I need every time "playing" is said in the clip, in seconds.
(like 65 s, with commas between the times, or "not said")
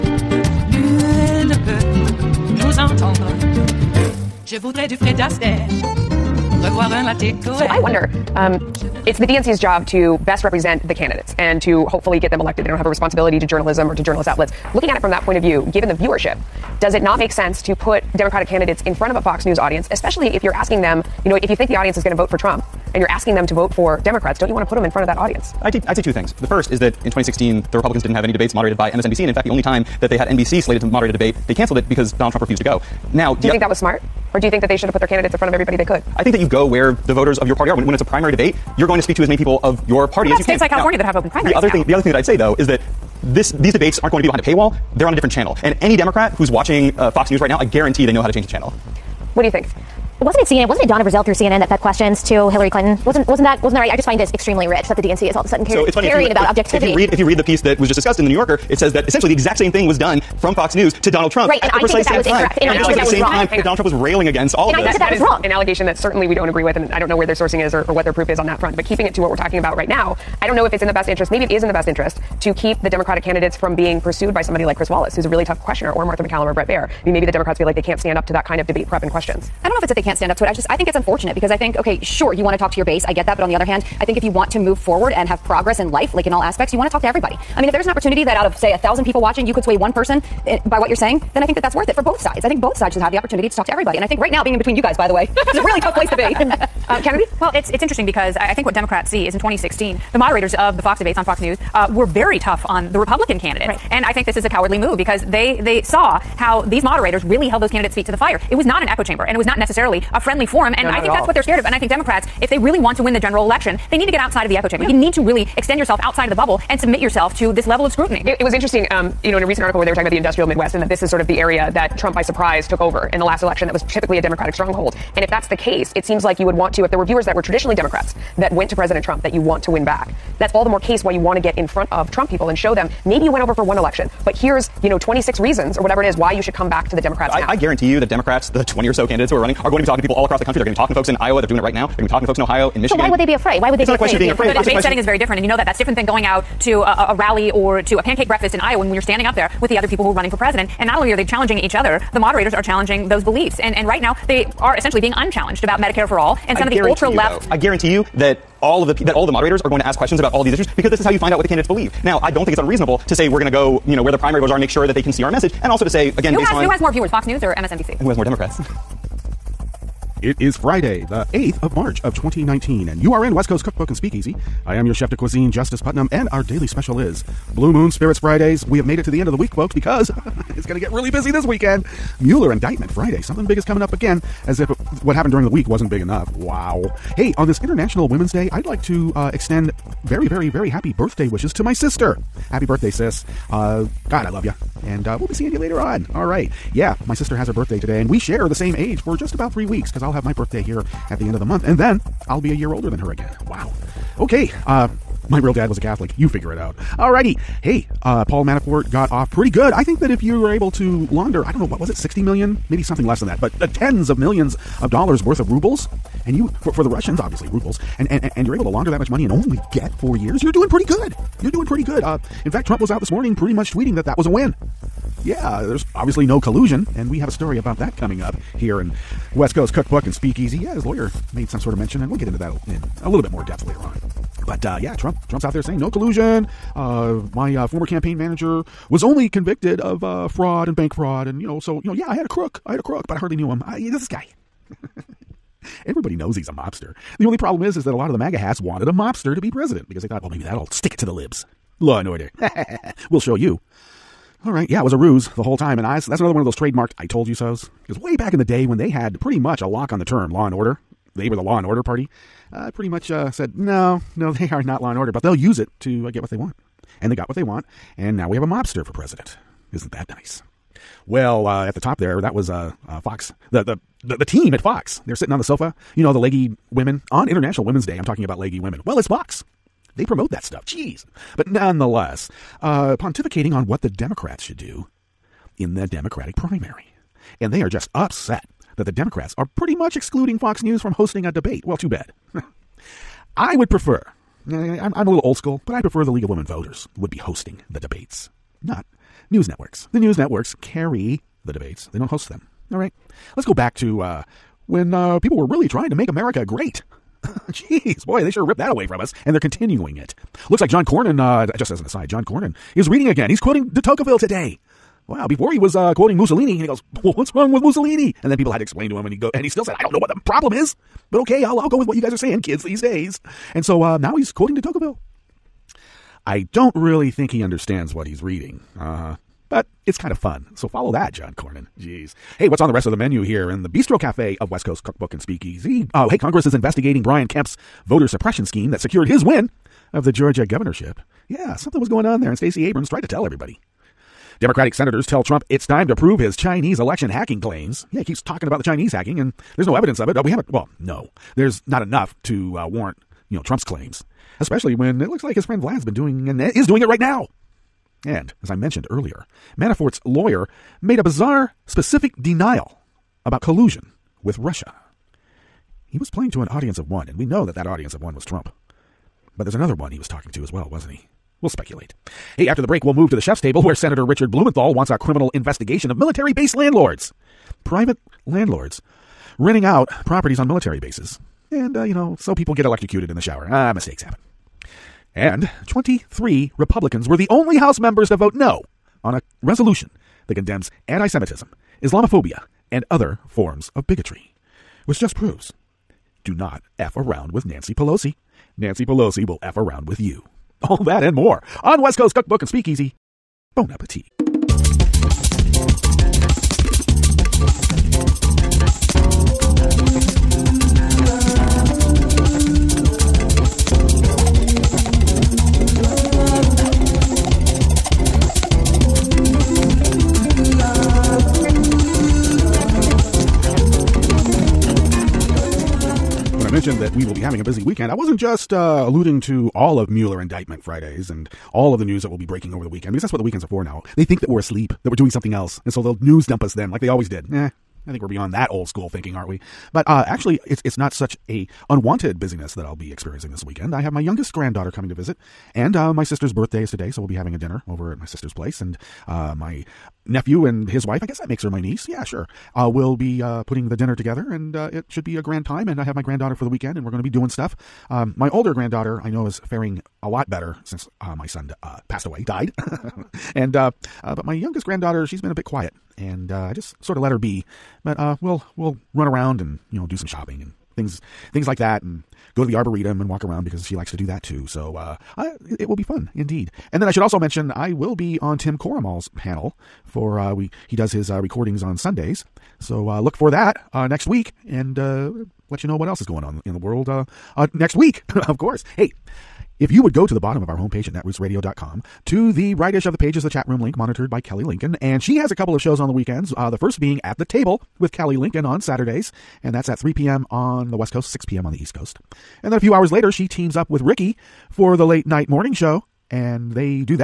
366 s.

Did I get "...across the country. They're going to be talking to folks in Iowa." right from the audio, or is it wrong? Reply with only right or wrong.
right.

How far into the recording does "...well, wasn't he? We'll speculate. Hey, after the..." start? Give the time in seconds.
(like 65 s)
370 s.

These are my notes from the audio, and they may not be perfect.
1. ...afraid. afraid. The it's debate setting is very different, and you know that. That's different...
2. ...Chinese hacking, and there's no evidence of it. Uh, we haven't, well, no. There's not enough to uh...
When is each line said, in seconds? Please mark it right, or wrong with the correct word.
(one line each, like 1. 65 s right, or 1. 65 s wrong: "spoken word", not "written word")
1. 144 s right
2. 348 s right.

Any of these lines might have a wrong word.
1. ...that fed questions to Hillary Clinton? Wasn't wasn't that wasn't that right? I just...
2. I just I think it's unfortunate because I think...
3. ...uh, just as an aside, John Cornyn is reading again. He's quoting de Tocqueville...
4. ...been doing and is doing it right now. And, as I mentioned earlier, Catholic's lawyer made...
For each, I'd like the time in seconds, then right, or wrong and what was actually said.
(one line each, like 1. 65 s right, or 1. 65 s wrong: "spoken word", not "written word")
1. 51 s right
2. 80 s right
3. 311 s right
4. 355 s wrong: "Manafort", not "Catholic".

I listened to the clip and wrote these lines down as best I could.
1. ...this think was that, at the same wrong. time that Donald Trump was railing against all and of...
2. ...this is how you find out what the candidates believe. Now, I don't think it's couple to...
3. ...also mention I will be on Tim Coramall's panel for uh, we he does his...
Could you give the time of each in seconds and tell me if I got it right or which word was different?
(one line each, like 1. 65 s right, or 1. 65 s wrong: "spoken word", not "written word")
1. 62 s right
2. 160 s wrong: "unreasonable", not "couple"
3. 477 s right.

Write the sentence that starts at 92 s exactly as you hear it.
I think both sides should have the opportunity to talk to everybody.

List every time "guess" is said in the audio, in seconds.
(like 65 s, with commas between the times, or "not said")
451 s.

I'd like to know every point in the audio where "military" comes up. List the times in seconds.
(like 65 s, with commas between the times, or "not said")
375 s, 380 s.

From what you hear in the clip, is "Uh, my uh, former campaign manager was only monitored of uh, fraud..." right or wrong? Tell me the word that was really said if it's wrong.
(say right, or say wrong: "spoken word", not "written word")
wrong: "convicted", not "monitored".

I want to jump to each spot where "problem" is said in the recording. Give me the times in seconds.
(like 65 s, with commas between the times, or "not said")
247 s, 320 s.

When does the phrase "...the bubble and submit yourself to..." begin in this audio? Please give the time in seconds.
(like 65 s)
116 s.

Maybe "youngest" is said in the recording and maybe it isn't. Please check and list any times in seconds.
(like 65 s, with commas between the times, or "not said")
444 s, 464 s.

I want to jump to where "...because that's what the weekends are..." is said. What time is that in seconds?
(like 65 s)
432 s.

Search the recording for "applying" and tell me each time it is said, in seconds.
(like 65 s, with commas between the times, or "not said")
not said.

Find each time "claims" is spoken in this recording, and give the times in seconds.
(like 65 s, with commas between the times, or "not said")
347 s, 353 s.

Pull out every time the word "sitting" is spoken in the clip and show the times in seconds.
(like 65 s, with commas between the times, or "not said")
275 s.